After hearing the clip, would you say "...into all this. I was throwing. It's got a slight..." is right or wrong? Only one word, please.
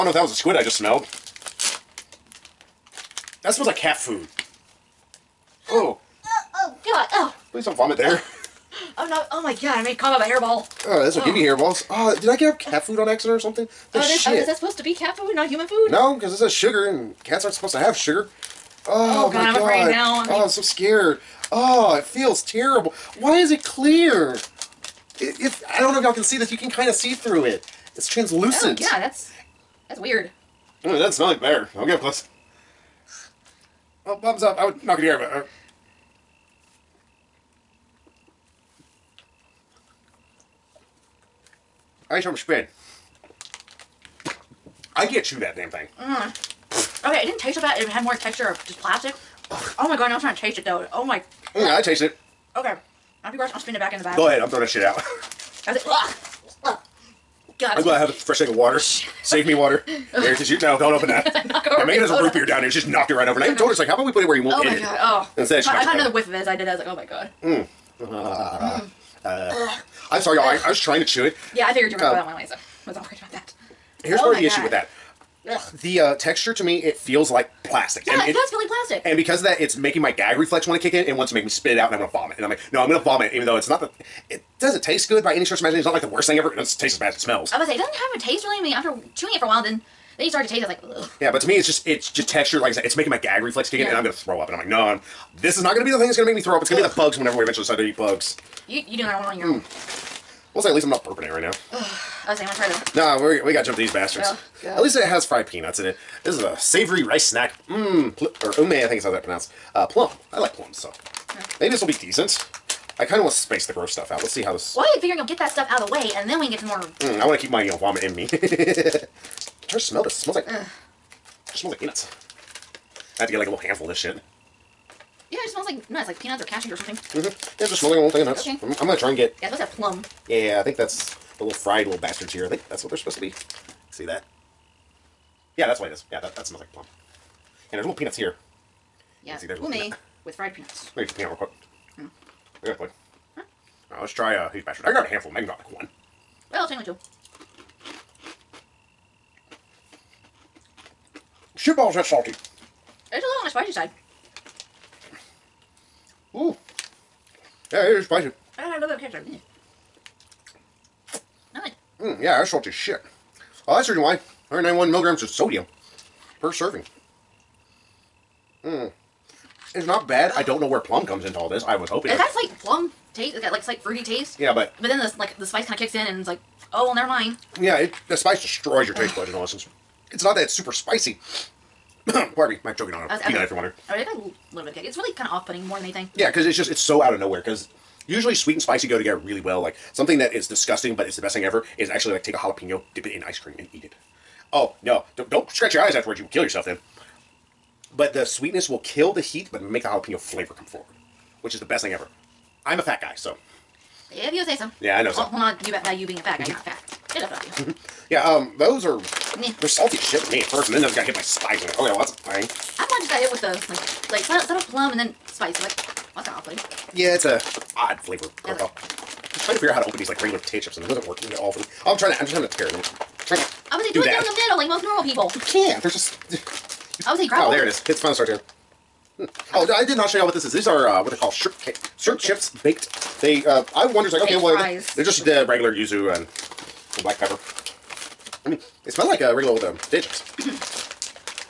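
wrong.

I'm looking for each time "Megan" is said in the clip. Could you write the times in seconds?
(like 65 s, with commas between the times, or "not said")
61 s, 145 s.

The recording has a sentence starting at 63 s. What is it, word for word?
And I oh even told her, it's like, how about we put it where you won't Oh hit my it?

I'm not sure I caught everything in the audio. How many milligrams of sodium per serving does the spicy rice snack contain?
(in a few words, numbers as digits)
191.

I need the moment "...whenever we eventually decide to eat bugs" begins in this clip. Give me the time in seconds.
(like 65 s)
97 s.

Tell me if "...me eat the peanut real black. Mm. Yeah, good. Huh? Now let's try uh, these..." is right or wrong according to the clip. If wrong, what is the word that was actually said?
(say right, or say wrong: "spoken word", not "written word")
wrong: "quick", not "black".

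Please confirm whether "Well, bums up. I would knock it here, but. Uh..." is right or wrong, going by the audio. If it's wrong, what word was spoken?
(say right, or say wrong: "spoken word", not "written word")
right.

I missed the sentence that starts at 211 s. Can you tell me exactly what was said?
oh yeah, well that's a thing.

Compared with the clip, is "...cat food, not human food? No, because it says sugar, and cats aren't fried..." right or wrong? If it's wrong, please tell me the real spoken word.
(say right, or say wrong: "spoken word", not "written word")
wrong: "supposed", not "fried".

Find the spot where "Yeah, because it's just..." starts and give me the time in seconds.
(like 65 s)
186 s.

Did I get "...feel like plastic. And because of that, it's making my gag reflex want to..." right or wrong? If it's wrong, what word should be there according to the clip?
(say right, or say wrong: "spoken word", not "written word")
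right.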